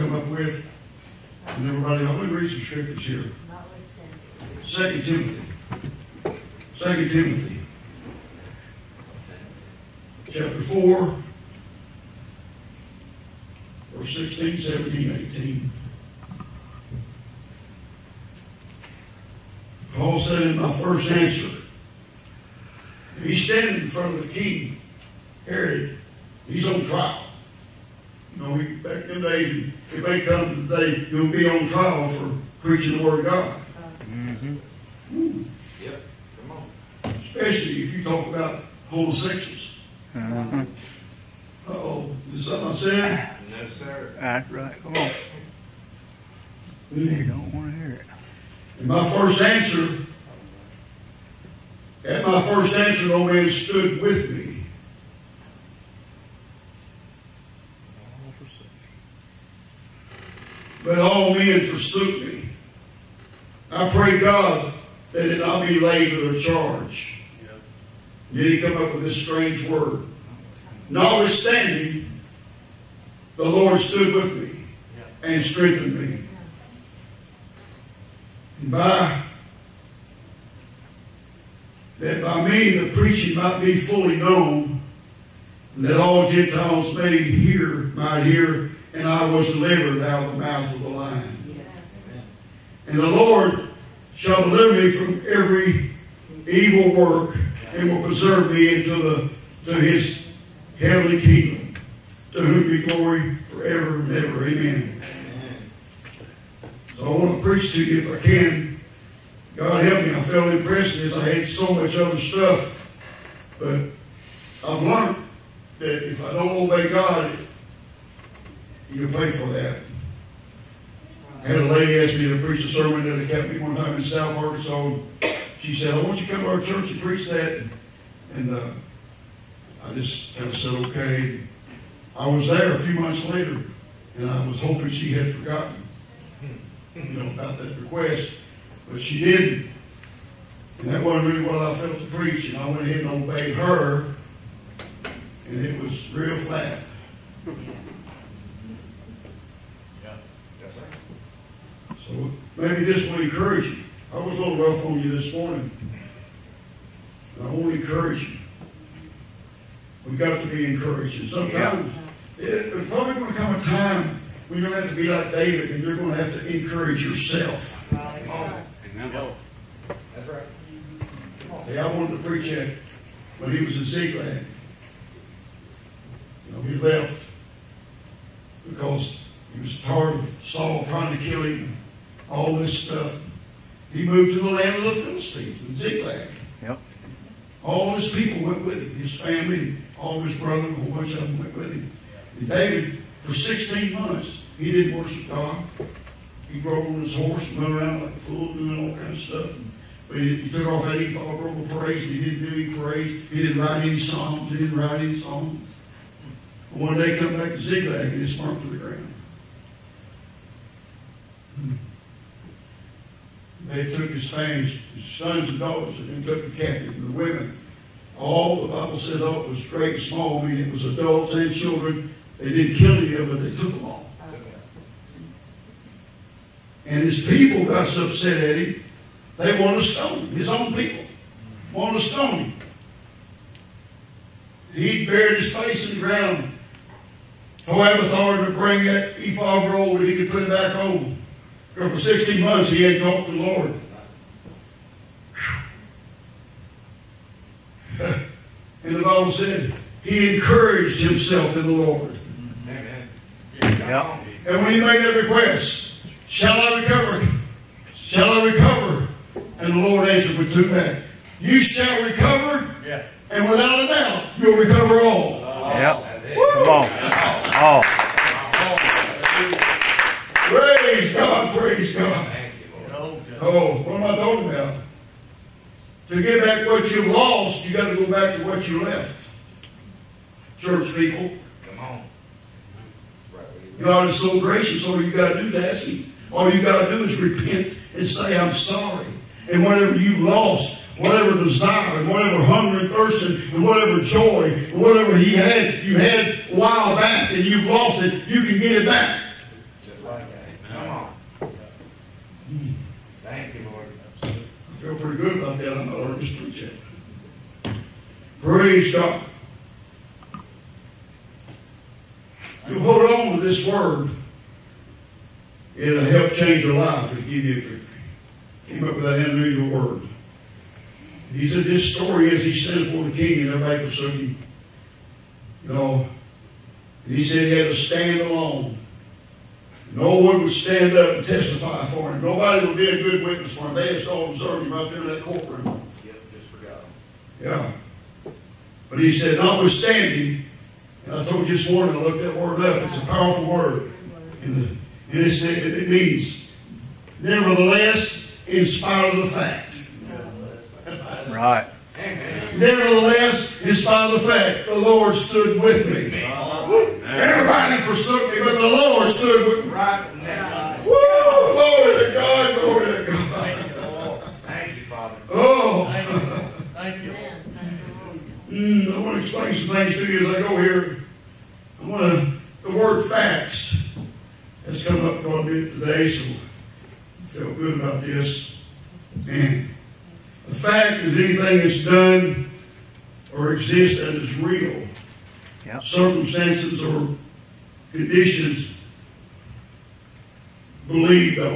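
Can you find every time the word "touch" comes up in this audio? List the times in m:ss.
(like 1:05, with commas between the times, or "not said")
not said.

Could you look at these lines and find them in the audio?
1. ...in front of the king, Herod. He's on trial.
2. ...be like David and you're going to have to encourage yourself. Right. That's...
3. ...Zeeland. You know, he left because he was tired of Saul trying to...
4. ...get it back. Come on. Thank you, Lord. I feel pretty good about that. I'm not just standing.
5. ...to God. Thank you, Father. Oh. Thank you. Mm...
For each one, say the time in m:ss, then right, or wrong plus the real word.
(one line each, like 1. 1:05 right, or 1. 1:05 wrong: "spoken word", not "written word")
1. 0:23 right
2. 2:45 right
3. 2:53 right
4. 4:58 wrong: "preaching", not "standing"
5. 6:02 right.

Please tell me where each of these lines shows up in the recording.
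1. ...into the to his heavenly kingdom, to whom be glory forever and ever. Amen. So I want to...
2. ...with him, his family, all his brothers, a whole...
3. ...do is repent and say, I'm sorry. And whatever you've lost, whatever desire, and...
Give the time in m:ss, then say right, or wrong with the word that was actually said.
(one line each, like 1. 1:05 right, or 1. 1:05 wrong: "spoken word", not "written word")
1. 1:38 right
2. 3:08 right
3. 4:46 right.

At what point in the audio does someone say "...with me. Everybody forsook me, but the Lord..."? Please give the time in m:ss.
5:55.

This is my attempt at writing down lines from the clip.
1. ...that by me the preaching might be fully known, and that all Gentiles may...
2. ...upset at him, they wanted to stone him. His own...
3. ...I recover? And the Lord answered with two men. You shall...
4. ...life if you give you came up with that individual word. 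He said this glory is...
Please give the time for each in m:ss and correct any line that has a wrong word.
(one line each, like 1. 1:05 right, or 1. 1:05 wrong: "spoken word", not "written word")
1. 1:21 right
2. 3:48 right
3. 4:18 right
4. 5:16 wrong: "story", not "glory".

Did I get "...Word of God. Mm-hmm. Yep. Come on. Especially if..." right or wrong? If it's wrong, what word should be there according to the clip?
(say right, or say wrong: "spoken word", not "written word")
right.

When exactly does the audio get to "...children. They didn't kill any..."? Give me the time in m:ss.
3:41.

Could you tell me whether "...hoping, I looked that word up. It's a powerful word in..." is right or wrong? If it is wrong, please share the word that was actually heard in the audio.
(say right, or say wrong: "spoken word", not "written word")
wrong: "morning", not "hoping".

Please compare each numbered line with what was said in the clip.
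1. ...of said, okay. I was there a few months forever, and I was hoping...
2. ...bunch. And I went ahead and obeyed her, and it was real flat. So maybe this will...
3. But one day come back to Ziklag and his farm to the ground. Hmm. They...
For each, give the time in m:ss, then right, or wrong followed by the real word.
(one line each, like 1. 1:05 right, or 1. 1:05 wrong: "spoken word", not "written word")
1. 2:10 wrong: "later", not "forever"
2. 2:22 wrong: "preach", not "bunch"
3. 3:26 right.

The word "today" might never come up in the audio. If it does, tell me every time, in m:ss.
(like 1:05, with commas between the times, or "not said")
0:30, 6:15.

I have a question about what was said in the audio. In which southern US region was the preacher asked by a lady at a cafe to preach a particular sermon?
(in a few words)
South Arkansas.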